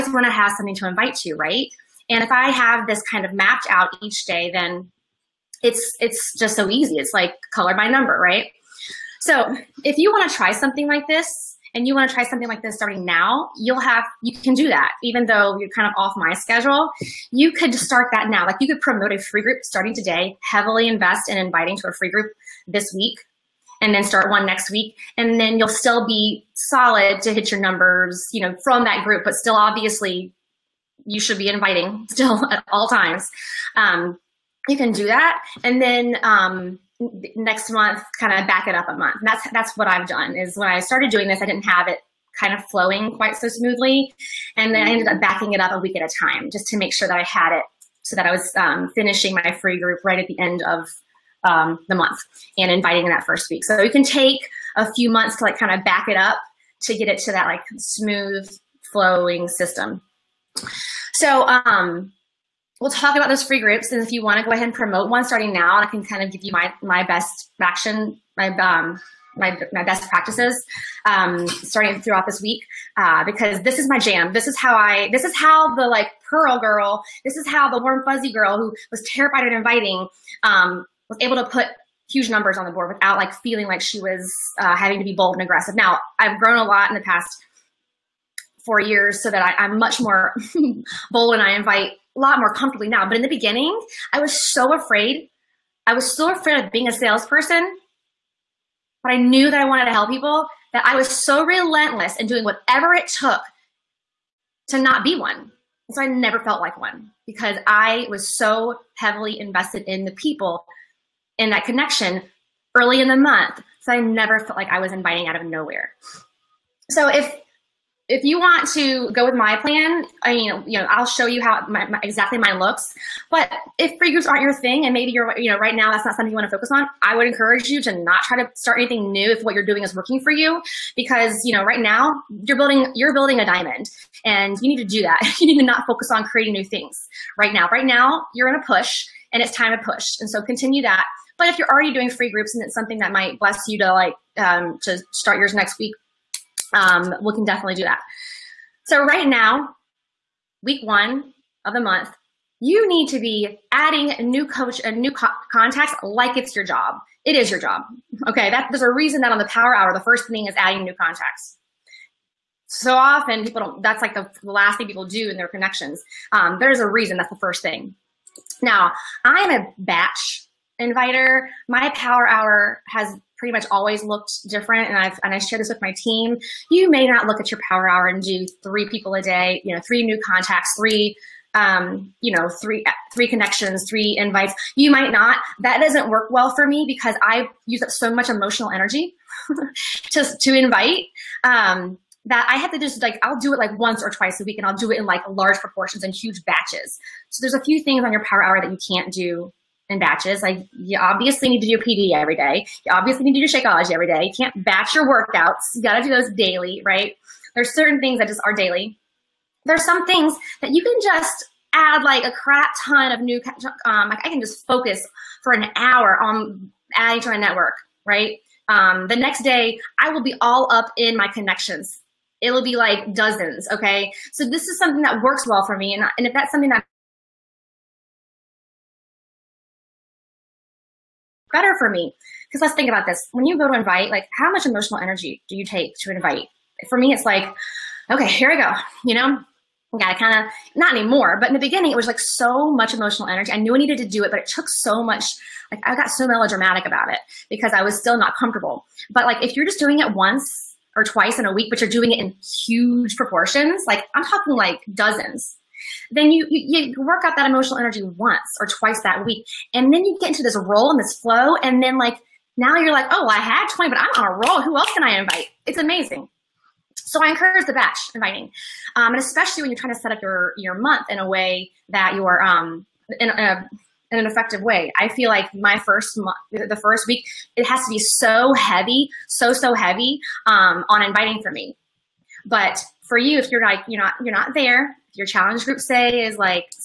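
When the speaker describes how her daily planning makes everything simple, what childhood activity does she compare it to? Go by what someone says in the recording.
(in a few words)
Color by number.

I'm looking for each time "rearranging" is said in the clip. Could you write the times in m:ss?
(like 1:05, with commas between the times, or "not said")
not said.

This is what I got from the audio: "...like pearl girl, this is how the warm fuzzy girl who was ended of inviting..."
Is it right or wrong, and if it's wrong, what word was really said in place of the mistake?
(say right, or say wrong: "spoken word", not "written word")
wrong: "terrified", not "ended".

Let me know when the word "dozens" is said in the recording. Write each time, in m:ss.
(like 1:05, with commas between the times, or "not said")
3:43, 4:14.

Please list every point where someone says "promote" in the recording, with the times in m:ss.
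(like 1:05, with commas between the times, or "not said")
0:18, 1:04.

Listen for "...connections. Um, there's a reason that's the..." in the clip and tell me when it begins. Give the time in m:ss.
2:45.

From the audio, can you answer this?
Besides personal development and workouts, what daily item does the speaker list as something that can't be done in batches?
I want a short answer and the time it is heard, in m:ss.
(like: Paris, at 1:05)
Shakeology, at 3:23.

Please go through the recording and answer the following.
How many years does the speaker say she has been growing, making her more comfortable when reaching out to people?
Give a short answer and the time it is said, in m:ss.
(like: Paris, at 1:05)
4, at 1:28.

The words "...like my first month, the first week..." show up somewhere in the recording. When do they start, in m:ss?
4:35.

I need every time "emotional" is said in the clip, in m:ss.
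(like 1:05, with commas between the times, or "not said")
3:08, 3:54, 4:02, 4:17.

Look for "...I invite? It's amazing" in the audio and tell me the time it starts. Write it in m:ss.
4:25.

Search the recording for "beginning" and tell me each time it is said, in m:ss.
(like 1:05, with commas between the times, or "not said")
1:33, 4:01.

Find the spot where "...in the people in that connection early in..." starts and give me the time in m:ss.
1:49.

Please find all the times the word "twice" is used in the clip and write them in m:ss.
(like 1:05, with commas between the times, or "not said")
3:14, 4:11, 4:18.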